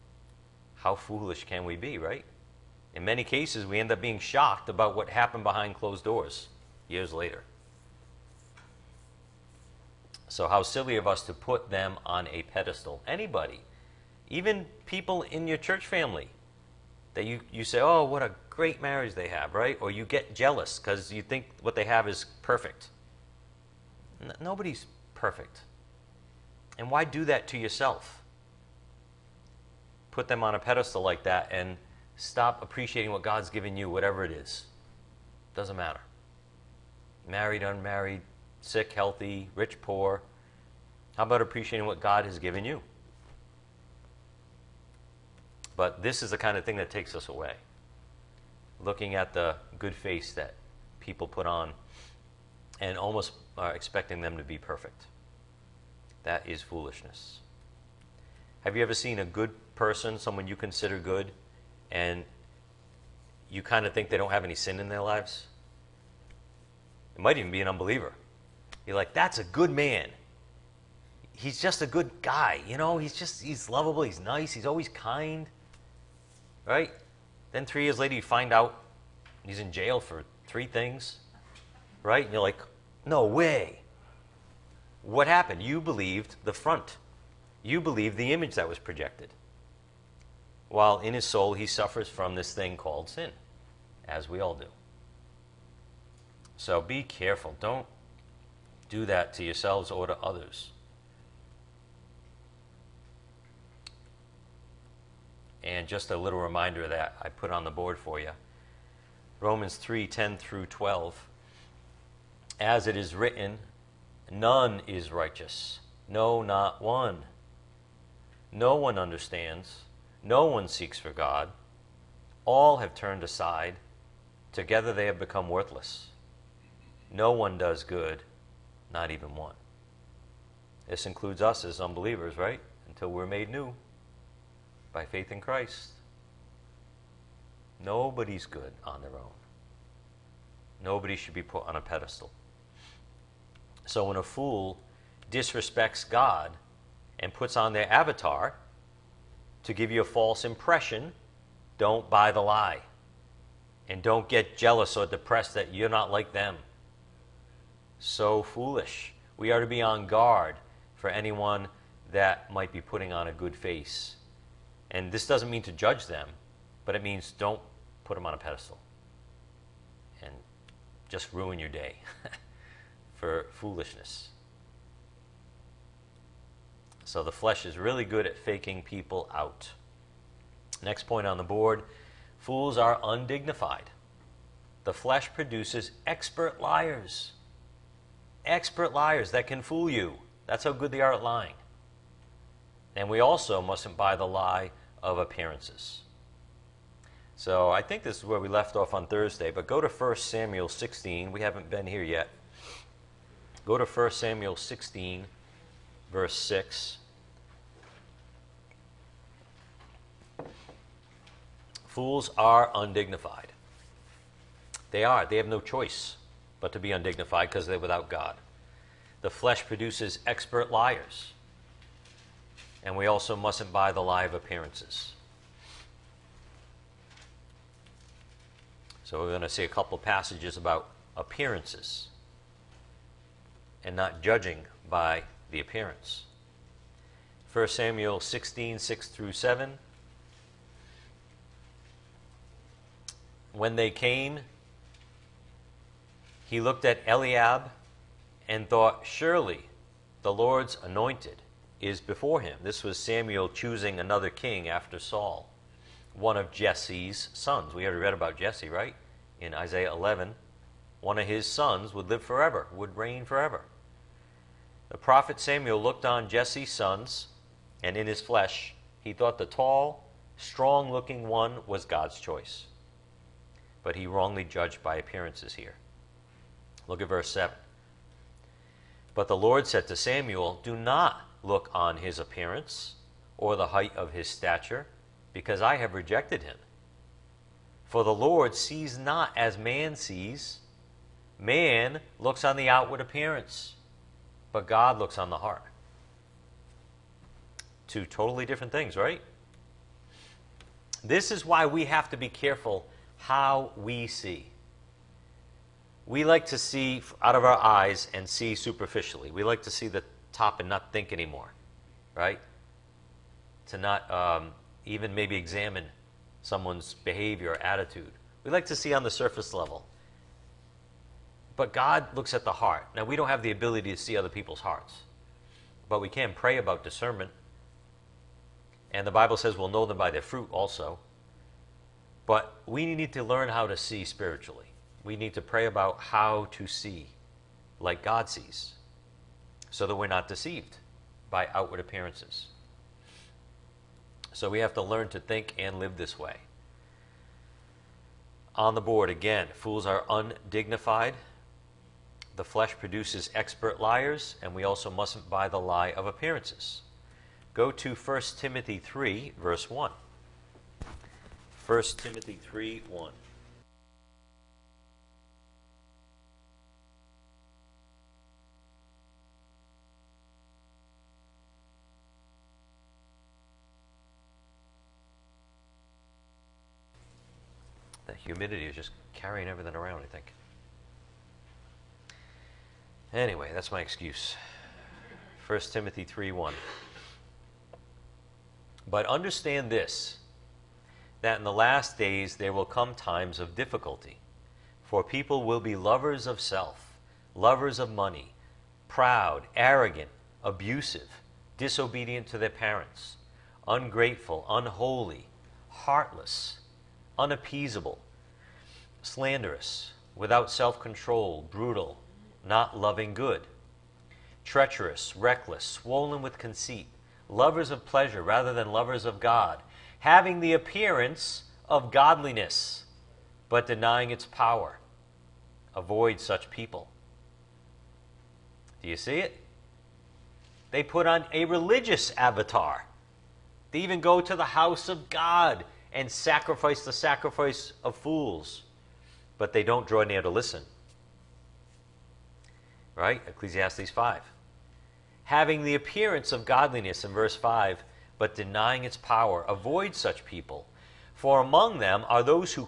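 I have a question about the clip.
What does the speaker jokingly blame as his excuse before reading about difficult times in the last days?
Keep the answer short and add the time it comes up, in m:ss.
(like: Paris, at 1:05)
The humidity, at 6:18.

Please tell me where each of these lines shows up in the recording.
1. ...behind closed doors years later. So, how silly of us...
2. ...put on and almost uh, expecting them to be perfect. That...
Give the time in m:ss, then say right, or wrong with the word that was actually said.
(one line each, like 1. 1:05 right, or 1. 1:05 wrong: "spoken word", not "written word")
1. 0:05 right
2. 0:51 right.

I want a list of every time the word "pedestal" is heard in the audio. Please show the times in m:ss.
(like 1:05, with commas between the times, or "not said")
0:12, 0:30, 2:21, 2:48.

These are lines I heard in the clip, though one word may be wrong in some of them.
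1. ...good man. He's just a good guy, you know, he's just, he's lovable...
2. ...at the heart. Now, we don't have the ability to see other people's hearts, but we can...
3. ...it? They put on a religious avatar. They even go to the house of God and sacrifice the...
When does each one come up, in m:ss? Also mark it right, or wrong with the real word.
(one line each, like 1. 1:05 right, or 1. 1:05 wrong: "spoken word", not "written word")
1. 1:09 right
2. 5:22 right
3. 7:09 right.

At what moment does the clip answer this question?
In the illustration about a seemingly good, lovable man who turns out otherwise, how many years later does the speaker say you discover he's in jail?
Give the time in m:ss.
1:17.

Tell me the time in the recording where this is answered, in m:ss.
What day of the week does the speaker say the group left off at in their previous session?
3:19.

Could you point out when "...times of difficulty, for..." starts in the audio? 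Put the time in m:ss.
6:32.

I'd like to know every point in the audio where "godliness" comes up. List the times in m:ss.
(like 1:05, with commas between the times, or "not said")
7:01, 7:26.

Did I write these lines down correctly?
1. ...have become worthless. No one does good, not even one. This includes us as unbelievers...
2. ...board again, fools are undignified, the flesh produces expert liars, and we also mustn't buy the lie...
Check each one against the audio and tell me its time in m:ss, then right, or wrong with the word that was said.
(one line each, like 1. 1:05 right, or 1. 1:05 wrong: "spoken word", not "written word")
1. 2:05 right
2. 5:48 right.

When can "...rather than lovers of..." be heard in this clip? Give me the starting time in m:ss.
6:58.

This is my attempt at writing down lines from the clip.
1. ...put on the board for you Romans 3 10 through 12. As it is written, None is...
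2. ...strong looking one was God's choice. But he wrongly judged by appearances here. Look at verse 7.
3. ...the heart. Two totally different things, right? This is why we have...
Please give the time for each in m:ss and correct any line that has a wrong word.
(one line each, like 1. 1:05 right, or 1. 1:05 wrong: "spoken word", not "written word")
1. 1:47 right
2. 4:30 right
3. 4:55 right.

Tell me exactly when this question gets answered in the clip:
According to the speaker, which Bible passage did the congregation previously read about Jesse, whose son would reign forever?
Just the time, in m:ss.
4:19.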